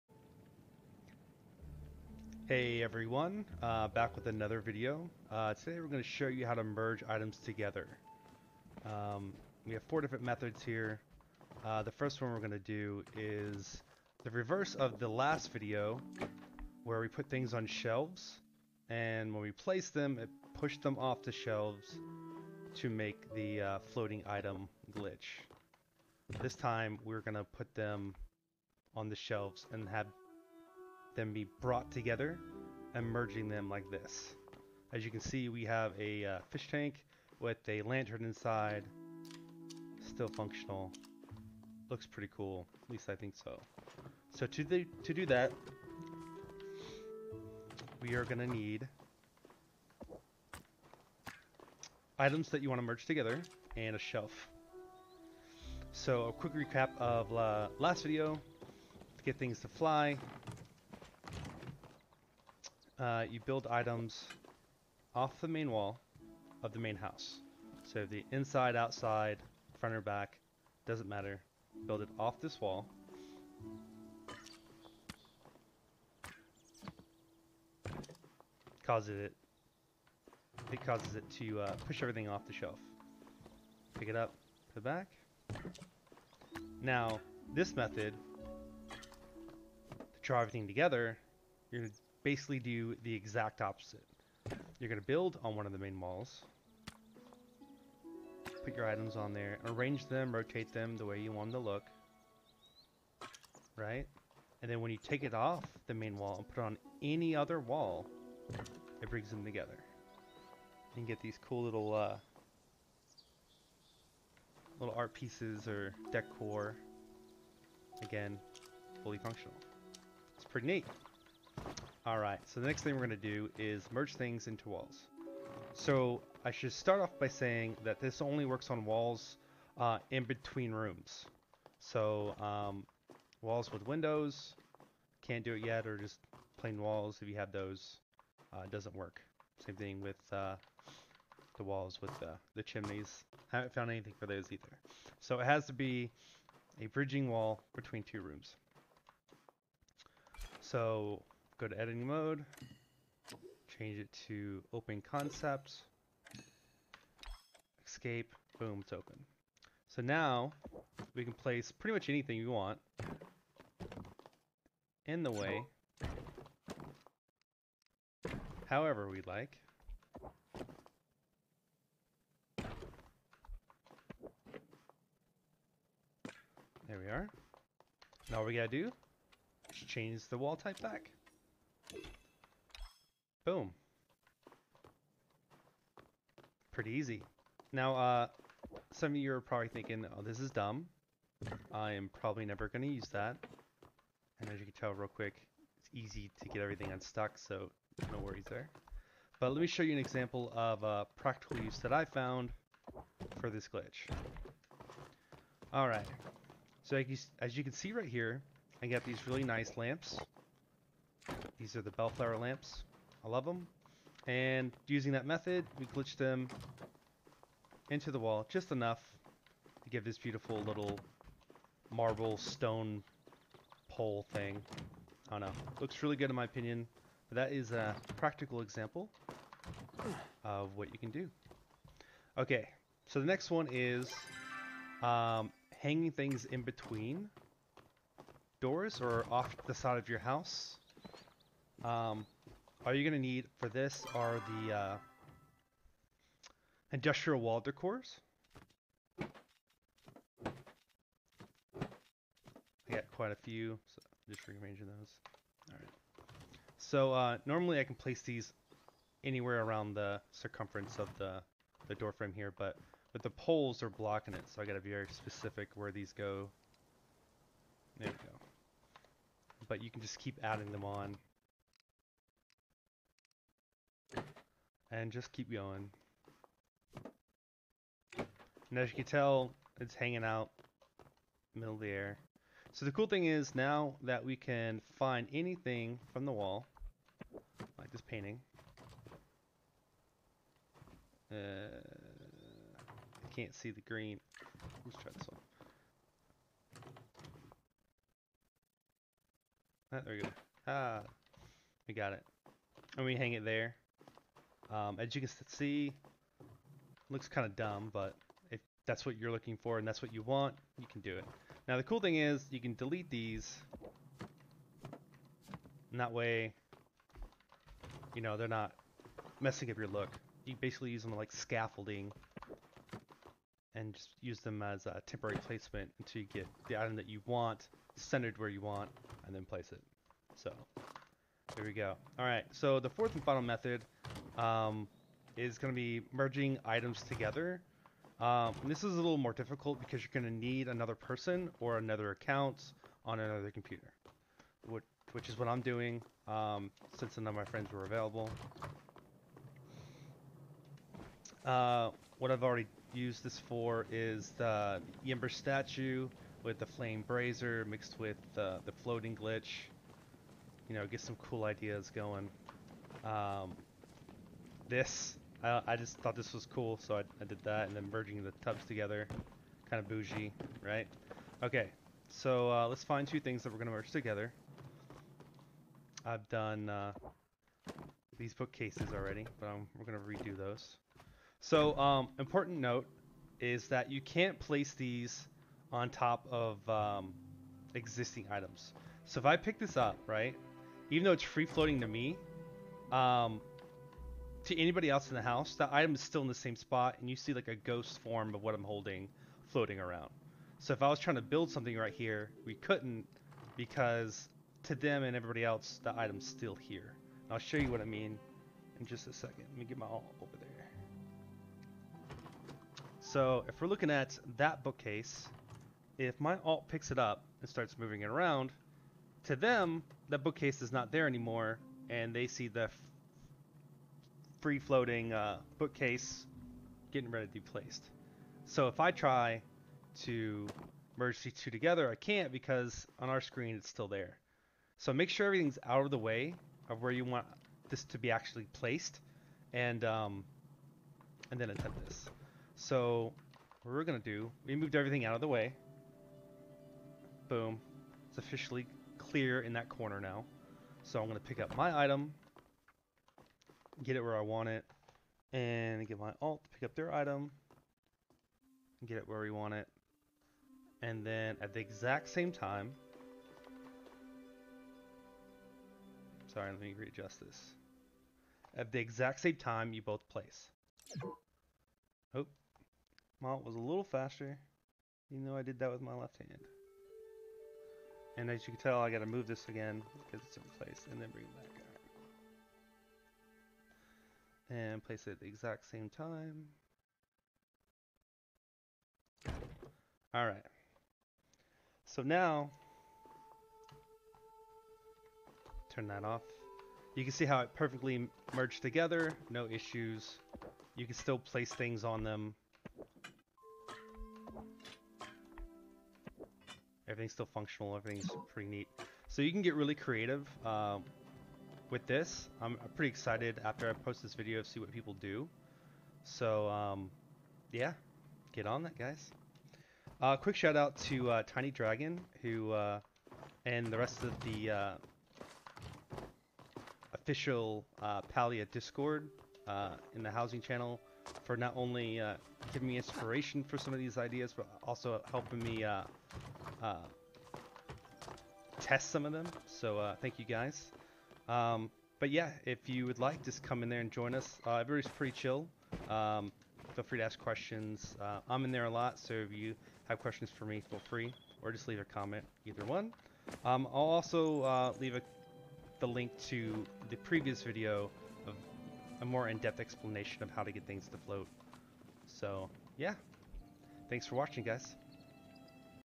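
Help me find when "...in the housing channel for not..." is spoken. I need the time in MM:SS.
08:49.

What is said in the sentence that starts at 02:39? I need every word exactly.
So now we can place pretty much anything we want in the way however we like.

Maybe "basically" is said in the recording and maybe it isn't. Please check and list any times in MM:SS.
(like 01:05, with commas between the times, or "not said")
01:32, 05:20.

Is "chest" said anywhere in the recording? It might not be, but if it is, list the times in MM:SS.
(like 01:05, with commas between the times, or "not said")
not said.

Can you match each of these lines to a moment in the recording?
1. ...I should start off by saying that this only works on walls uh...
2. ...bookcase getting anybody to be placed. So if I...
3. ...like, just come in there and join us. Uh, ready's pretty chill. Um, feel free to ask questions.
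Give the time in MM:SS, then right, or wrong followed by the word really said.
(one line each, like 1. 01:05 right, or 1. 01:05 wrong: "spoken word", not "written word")
1. 02:06 right
2. 07:05 wrong: "ready", not "anybody"
3. 09:02 wrong: "everybody", not "ready".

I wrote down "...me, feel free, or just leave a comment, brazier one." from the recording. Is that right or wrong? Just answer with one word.
wrong.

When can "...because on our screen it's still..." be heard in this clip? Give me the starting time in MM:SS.
07:12.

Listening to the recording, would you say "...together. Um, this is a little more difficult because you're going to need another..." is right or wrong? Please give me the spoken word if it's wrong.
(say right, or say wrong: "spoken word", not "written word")
right.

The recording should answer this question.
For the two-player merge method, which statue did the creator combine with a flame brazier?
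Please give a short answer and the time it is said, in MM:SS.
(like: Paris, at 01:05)
Yember statue, at 05:55.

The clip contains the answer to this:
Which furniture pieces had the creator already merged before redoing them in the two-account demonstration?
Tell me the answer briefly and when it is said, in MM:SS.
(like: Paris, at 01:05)
Bookcases, at 06:18.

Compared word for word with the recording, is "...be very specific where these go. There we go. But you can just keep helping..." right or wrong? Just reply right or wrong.
wrong.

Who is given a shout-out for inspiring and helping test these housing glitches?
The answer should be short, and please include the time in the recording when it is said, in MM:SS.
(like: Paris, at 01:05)
Tiny Dragon, at 08:41.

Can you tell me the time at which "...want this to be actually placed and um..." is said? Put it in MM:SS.
07:17.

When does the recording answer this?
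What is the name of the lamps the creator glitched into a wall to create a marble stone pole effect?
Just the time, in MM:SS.
03:31.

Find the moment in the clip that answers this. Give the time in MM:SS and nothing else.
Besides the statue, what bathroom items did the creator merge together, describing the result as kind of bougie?
06:08.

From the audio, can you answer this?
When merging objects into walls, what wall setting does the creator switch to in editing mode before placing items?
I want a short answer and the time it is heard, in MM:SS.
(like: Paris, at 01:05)
Open concept, at 02:34.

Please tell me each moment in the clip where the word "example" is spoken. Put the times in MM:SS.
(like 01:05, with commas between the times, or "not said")
03:19, 03:48.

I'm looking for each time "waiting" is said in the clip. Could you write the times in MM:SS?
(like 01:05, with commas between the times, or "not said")
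not said.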